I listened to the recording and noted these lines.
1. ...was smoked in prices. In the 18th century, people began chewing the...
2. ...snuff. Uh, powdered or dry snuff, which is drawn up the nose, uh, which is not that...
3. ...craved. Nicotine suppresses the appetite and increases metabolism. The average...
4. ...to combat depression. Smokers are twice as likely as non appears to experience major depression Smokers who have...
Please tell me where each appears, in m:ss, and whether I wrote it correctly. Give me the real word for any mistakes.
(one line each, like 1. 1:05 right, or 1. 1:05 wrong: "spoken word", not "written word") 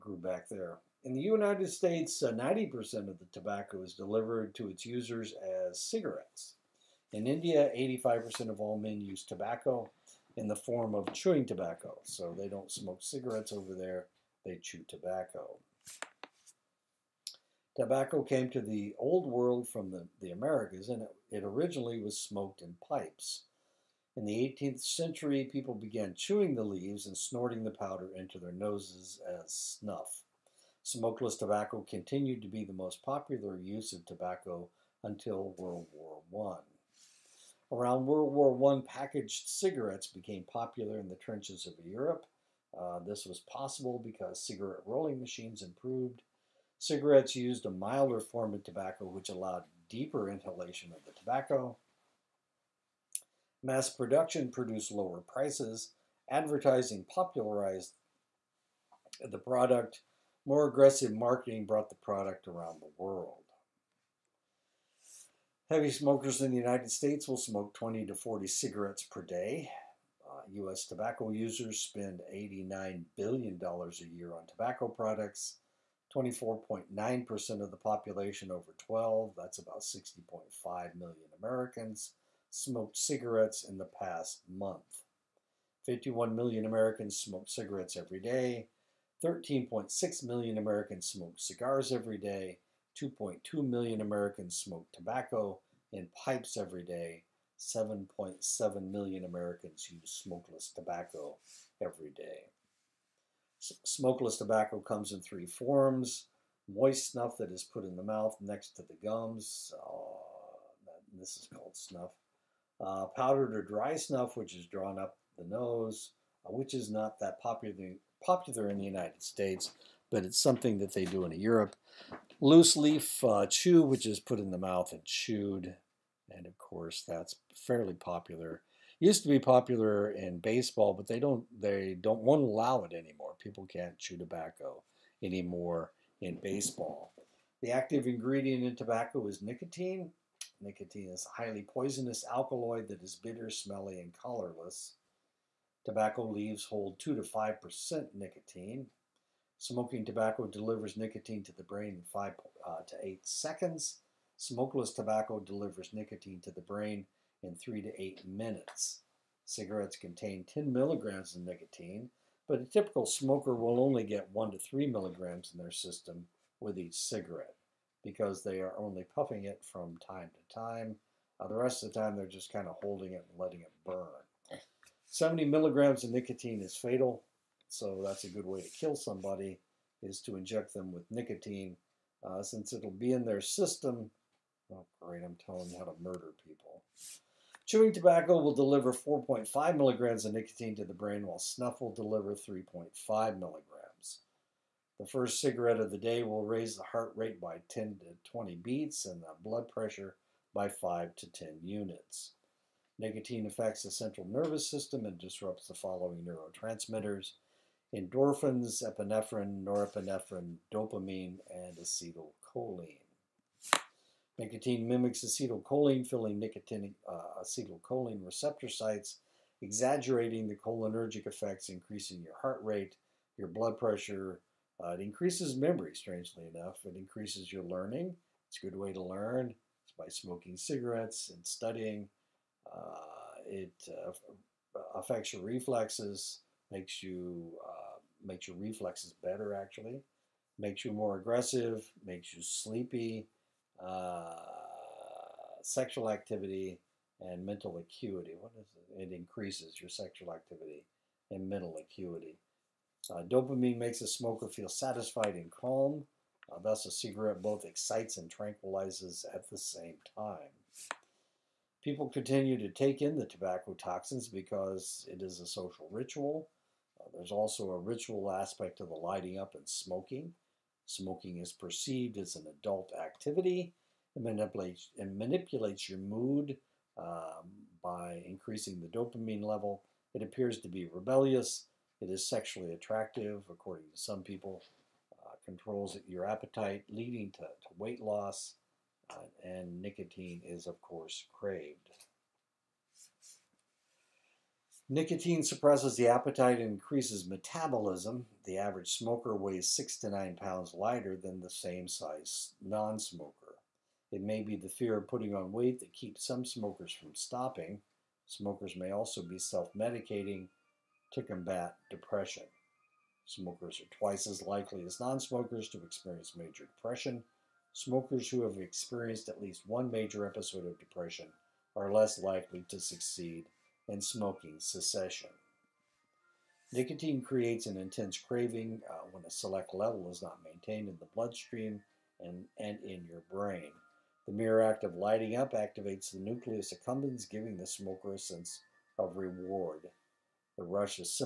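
1. 0:22 wrong: "pipes", not "prices"
2. 1:51 right
3. 4:51 right
4. 5:11 wrong: "smokers", not "appears".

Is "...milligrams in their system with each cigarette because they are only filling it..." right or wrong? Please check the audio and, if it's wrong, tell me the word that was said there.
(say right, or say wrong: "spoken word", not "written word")
wrong: "puffing", not "filling".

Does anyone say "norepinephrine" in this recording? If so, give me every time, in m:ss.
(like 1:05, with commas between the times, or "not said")
3:29.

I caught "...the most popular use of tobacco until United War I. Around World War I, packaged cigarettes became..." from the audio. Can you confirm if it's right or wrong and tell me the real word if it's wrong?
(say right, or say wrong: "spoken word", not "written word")
wrong: "World", not "United".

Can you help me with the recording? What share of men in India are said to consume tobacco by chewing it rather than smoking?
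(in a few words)
85%.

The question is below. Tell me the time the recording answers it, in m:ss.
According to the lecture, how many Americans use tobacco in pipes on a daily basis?
1:33.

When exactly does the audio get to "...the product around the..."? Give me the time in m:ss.
1:01.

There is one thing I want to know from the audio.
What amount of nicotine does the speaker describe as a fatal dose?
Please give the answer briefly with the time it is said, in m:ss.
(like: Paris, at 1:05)
70 milligrams, at 2:55.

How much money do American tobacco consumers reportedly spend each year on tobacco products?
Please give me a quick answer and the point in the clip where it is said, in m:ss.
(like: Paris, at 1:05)
$89 billion, at 1:12.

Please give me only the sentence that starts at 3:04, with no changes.
Oh, great, I'm telling you how to murder people.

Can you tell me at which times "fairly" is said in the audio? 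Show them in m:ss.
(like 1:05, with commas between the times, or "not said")
2:07.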